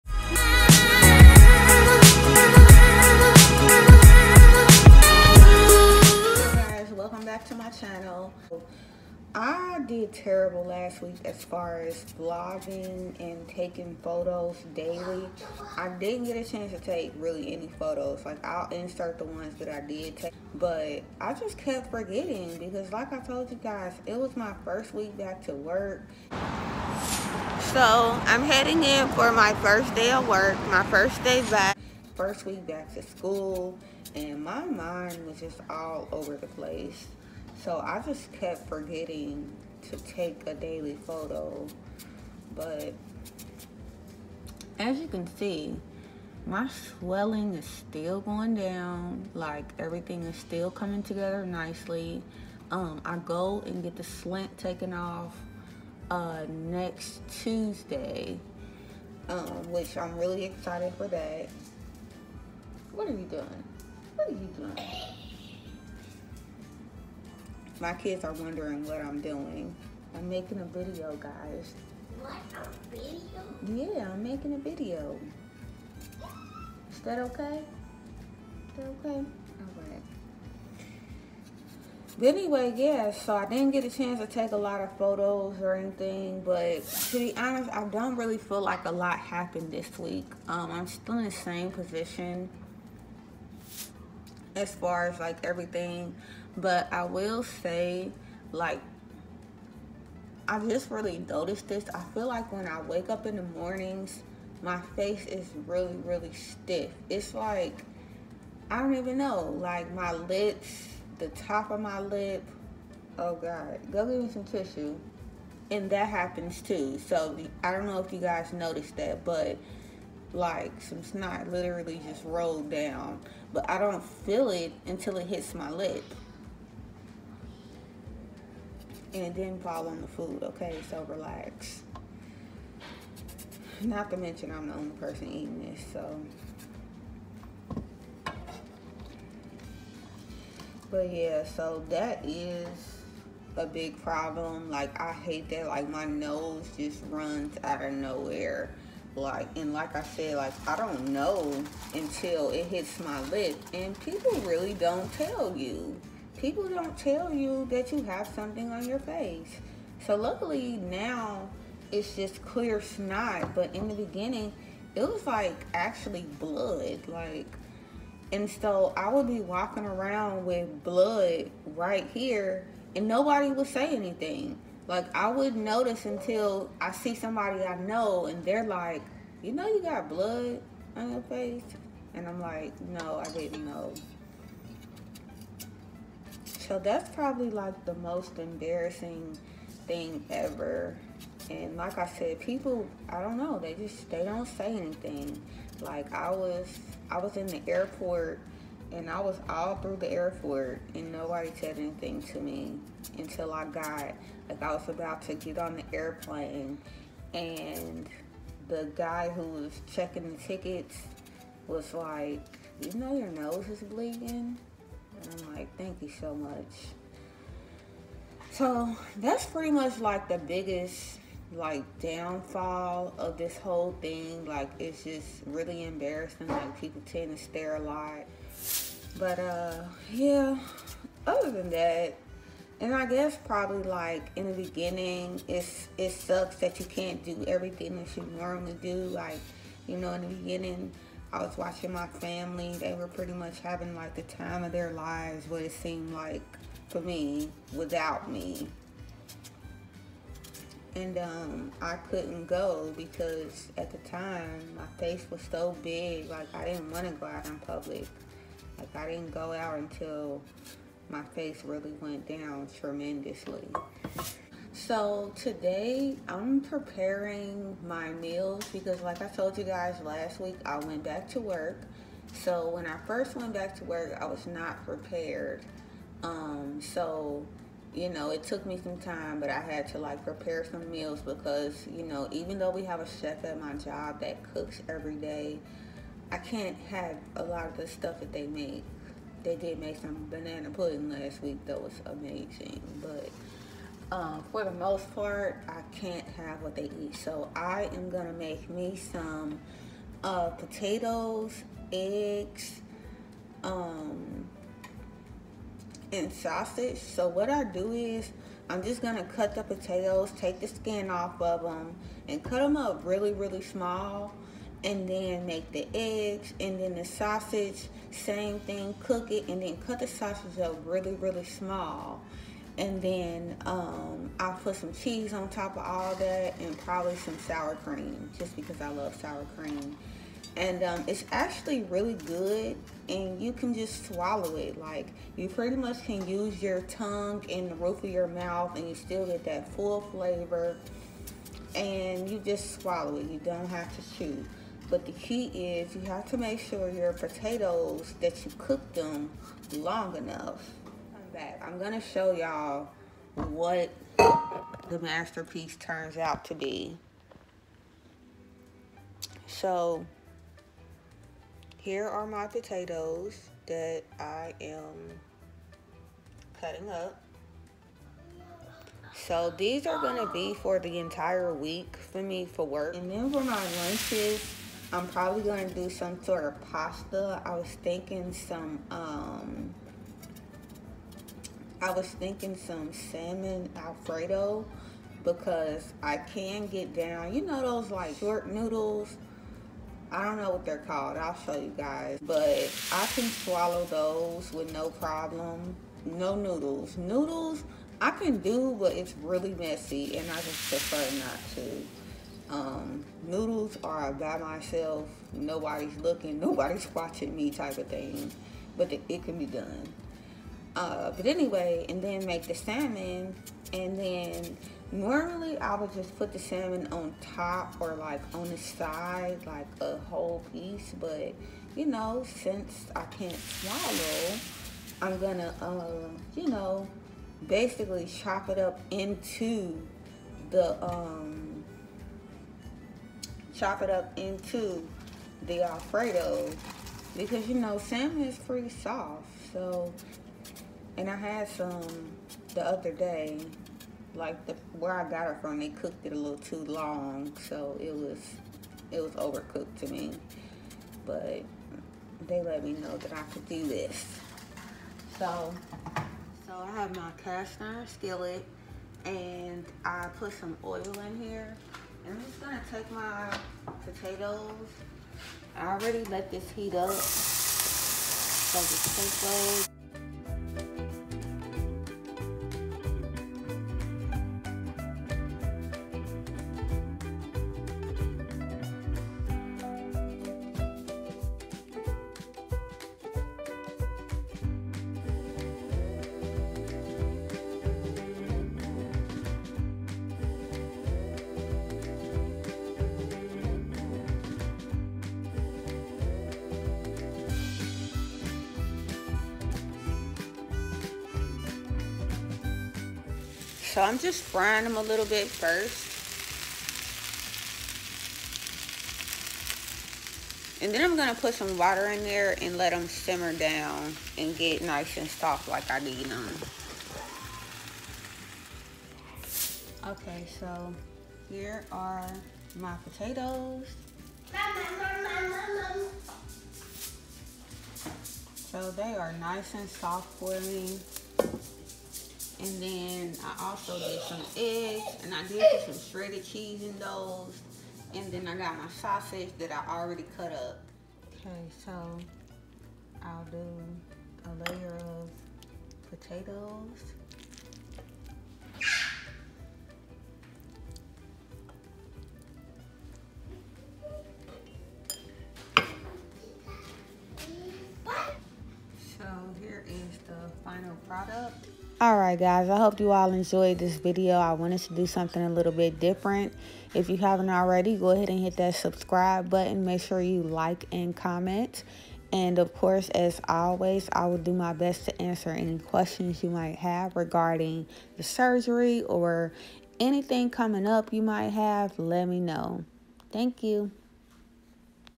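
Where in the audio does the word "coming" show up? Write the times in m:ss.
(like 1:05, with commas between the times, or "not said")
0:50, 9:40.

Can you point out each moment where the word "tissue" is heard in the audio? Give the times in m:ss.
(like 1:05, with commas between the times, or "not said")
1:54.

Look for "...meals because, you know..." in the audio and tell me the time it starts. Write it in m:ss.
4:40.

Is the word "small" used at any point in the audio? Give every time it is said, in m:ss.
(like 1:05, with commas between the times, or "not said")
5:13, 5:21.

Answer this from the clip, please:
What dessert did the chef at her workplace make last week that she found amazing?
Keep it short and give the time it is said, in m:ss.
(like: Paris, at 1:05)
Banana pudding, at 4:50.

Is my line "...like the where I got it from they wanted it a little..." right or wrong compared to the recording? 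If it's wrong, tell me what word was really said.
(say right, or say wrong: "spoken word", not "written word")
wrong: "cooked", not "wanted".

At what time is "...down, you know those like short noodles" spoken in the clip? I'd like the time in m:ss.
6:26.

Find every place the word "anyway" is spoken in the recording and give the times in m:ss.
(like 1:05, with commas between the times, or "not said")
1:22, 6:51.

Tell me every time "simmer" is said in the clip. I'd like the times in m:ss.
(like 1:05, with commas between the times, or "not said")
8:32.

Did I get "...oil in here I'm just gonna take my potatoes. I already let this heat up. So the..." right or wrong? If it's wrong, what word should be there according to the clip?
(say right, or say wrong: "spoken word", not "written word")
right.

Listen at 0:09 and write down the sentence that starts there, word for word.
I did terrible last week as far as vlogging and taking photos daily.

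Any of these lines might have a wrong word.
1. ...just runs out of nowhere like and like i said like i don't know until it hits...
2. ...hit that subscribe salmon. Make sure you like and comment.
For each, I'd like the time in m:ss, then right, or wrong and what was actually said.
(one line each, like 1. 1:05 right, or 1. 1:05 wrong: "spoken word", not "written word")
1. 2:26 right
2. 9:28 wrong: "button", not "salmon".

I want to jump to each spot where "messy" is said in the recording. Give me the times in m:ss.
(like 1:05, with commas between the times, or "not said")
6:39.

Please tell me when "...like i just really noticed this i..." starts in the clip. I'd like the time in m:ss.
1:38.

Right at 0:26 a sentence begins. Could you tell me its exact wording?
So, I'm heading in for my first day of work, my first day back.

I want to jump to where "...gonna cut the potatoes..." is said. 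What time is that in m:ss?
5:09.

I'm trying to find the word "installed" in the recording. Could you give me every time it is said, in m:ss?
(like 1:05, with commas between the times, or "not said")
not said.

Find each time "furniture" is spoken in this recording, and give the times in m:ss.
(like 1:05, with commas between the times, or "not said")
not said.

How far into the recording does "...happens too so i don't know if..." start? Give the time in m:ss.
1:56.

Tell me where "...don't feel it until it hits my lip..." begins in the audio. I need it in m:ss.
2:03.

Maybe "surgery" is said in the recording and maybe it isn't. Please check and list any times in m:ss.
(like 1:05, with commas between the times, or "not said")
9:38.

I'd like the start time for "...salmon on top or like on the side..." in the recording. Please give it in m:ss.
6:56.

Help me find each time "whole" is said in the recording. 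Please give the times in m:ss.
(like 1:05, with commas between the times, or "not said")
3:43, 6:59.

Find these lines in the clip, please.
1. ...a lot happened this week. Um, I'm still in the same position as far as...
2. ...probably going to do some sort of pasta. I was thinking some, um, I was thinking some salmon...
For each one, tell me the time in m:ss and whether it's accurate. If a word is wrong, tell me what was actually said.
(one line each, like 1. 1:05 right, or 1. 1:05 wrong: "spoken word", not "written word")
1. 1:28 right
2. 6:15 right.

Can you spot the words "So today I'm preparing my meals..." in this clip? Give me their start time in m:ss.
4:24.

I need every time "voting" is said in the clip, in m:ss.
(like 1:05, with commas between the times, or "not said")
not said.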